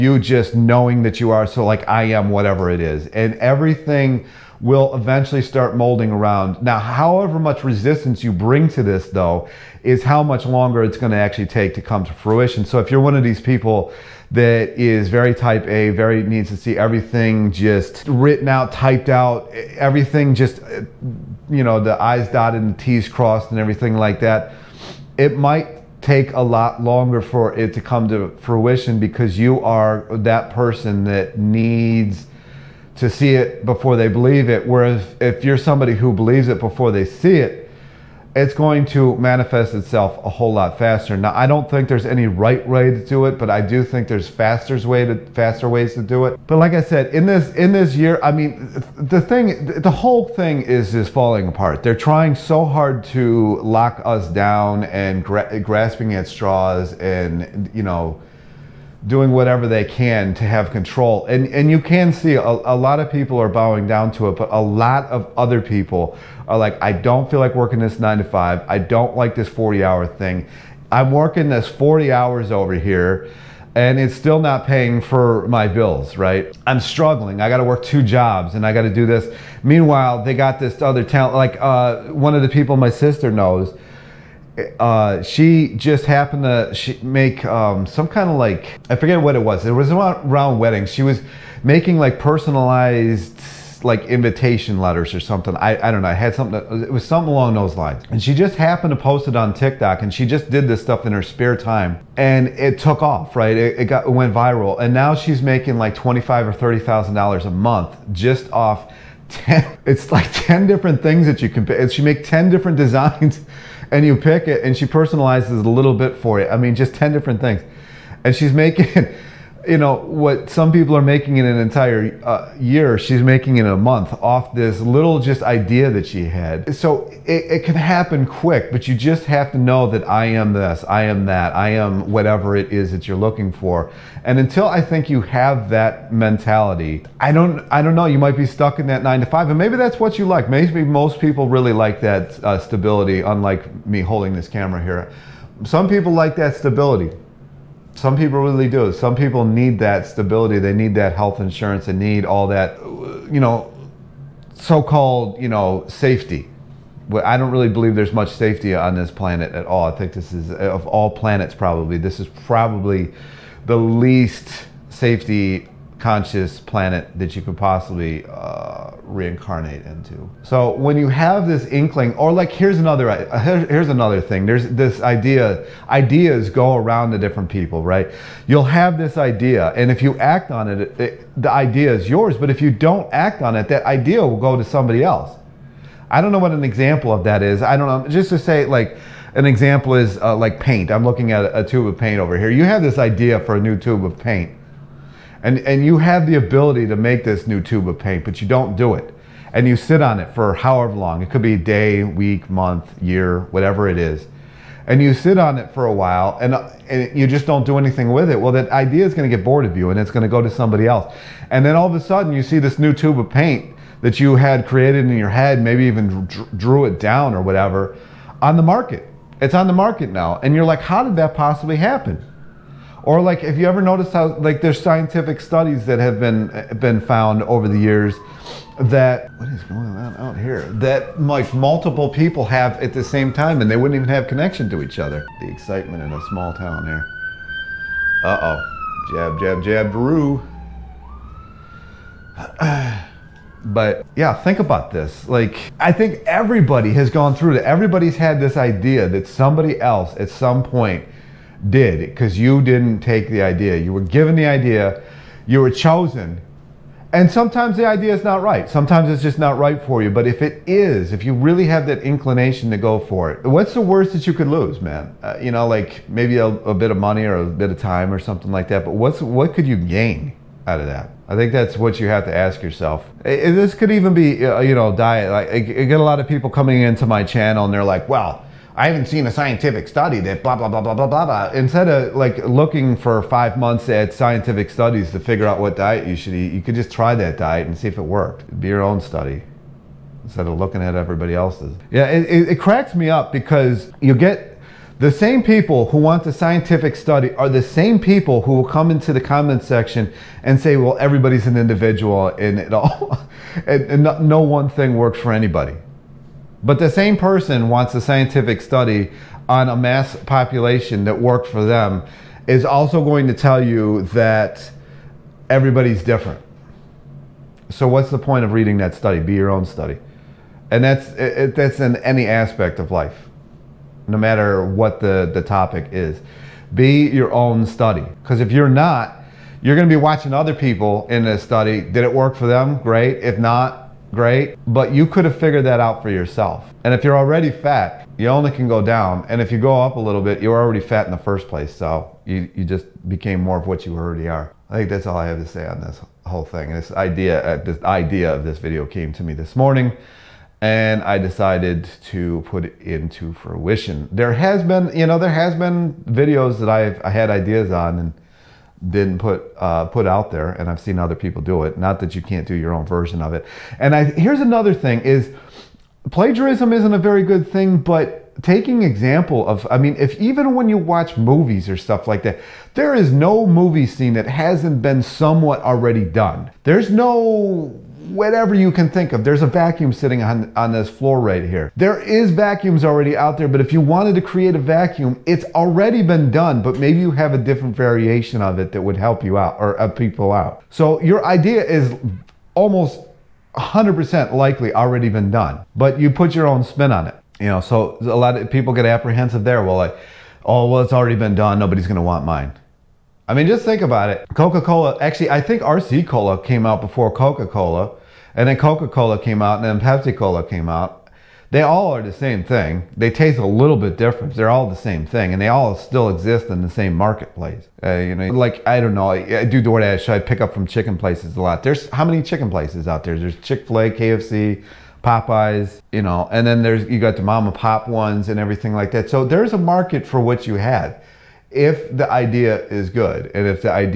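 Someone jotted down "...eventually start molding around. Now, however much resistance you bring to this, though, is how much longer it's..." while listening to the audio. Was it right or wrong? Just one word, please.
right.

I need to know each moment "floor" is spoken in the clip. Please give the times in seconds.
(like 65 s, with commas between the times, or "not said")
380 s.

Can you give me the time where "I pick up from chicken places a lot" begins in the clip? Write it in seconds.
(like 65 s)
420 s.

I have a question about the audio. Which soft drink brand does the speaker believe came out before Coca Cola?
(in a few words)
RC Cola.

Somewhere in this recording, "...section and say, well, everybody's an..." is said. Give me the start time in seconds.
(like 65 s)
299 s.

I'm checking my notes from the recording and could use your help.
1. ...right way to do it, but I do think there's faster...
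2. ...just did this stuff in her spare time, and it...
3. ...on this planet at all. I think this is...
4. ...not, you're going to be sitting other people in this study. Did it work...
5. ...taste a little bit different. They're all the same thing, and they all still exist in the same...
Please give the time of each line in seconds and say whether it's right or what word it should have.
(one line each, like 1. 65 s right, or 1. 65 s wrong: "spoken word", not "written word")
1. 42 s right
2. 100 s right
3. 158 s right
4. 328 s wrong: "watching", not "sitting"
5. 413 s right.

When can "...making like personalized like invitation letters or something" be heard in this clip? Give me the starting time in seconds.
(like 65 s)
91 s.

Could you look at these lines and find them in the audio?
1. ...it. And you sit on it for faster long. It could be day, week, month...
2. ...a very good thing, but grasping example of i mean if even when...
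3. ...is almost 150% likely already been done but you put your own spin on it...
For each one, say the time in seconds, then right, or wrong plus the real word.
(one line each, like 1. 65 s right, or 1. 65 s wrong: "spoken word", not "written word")
1. 198 s wrong: "however", not "faster"
2. 366 s wrong: "taking", not "grasping"
3. 391 s wrong: "100", not "150".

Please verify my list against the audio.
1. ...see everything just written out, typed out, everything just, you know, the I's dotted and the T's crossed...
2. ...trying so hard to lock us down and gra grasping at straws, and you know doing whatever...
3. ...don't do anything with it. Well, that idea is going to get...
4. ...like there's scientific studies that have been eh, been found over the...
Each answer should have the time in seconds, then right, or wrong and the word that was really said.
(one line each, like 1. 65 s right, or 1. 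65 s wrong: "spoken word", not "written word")
1. 16 s right
2. 51 s right
3. 207 s right
4. 224 s right.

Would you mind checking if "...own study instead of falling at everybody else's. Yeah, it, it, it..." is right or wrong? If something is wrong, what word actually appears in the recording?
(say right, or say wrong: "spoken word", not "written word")
wrong: "looking", not "falling".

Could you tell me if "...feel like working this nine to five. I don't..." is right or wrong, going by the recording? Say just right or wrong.
right.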